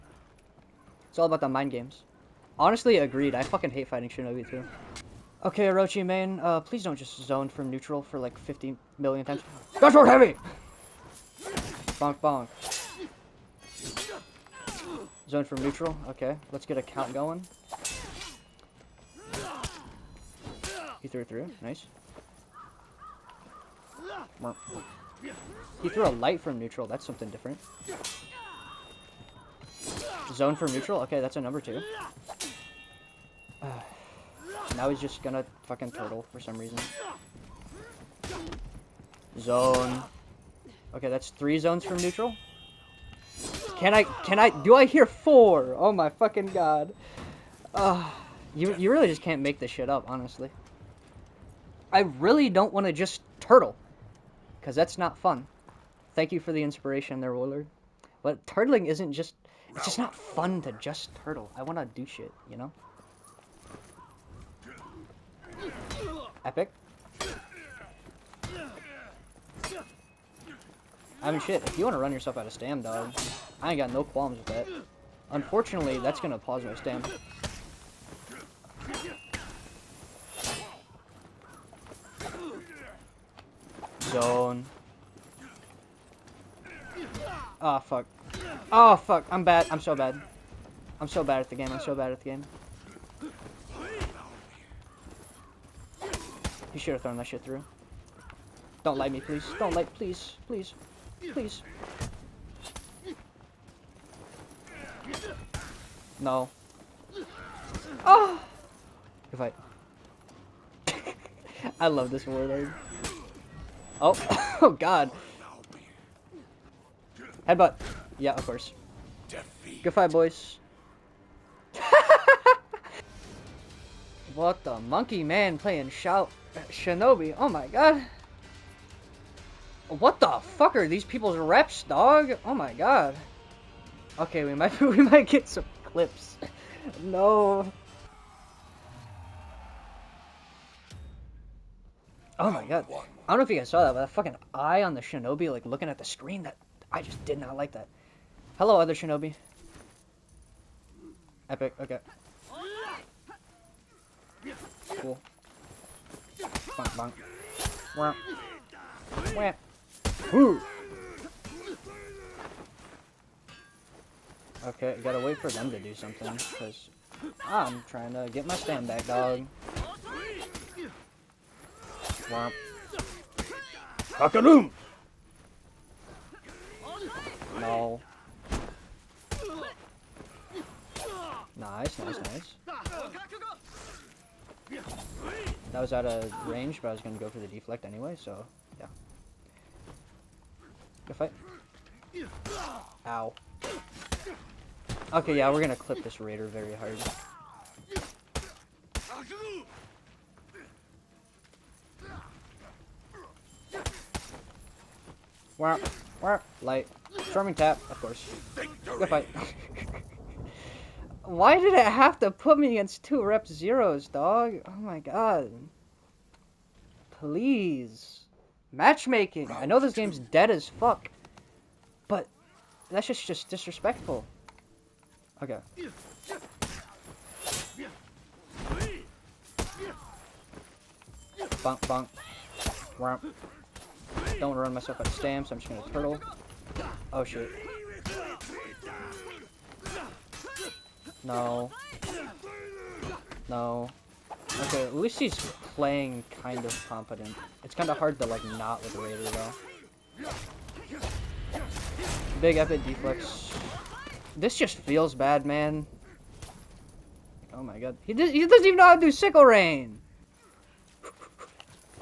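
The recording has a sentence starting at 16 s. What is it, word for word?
Okay, let's get a count going.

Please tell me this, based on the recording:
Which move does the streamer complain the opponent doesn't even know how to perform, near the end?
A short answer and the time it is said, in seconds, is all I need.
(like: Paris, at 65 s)
Sickle Rain, at 259 s.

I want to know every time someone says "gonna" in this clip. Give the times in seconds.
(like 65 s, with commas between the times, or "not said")
35 s.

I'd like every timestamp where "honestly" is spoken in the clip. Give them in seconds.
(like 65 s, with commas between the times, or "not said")
2 s, 50 s.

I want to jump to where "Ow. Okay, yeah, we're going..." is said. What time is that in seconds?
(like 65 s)
193 s.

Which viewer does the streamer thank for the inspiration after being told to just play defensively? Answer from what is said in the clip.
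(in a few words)
Willard.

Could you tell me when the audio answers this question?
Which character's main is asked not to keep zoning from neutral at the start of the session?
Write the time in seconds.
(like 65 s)
5 s.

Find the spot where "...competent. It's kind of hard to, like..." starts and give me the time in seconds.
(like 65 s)
246 s.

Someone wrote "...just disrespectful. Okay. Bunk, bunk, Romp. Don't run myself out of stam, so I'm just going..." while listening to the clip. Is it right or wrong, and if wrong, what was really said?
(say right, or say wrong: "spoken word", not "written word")
right.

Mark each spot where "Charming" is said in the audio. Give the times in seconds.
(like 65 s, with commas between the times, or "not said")
207 s.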